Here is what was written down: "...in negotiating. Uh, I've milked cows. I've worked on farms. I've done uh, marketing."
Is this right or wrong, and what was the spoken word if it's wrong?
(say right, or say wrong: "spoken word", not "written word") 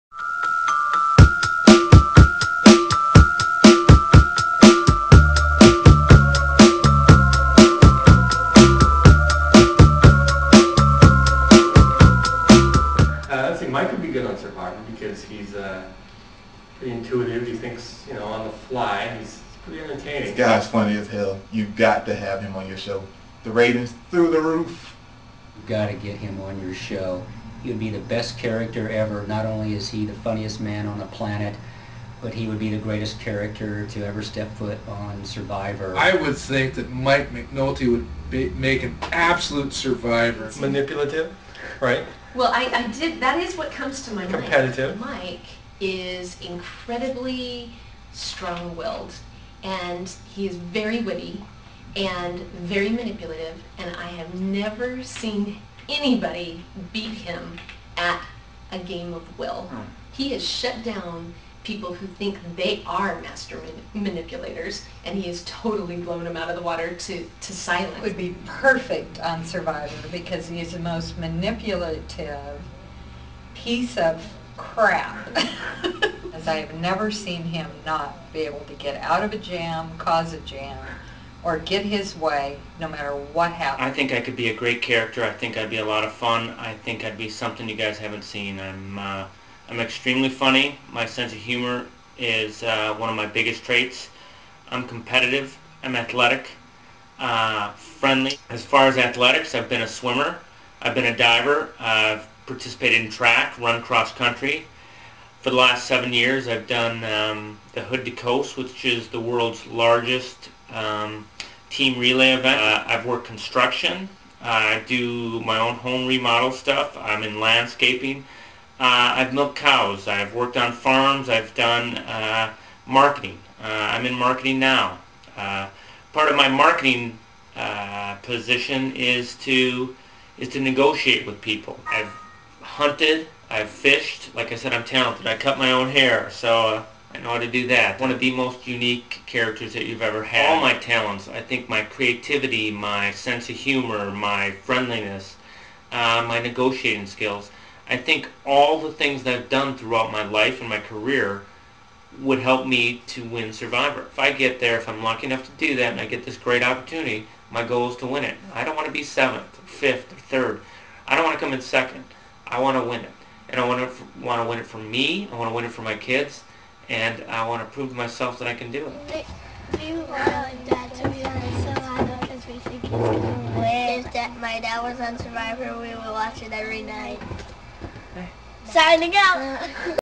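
wrong: "landscaping", not "negotiating".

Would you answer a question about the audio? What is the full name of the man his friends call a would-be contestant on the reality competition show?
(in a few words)
Mike McNulty.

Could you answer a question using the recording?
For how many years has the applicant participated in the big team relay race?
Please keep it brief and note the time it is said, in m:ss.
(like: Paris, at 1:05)
7, at 1:45.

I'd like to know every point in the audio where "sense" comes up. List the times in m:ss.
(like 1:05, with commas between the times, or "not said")
1:31, 2:23.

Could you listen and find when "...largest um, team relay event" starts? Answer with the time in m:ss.
1:49.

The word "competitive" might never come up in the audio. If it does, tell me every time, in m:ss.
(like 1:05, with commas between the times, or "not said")
0:44, 1:34.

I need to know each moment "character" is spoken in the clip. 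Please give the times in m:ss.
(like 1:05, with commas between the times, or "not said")
0:28, 0:33, 1:24, 2:19.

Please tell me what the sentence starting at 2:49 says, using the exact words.
We were to be on Survivor because we think win.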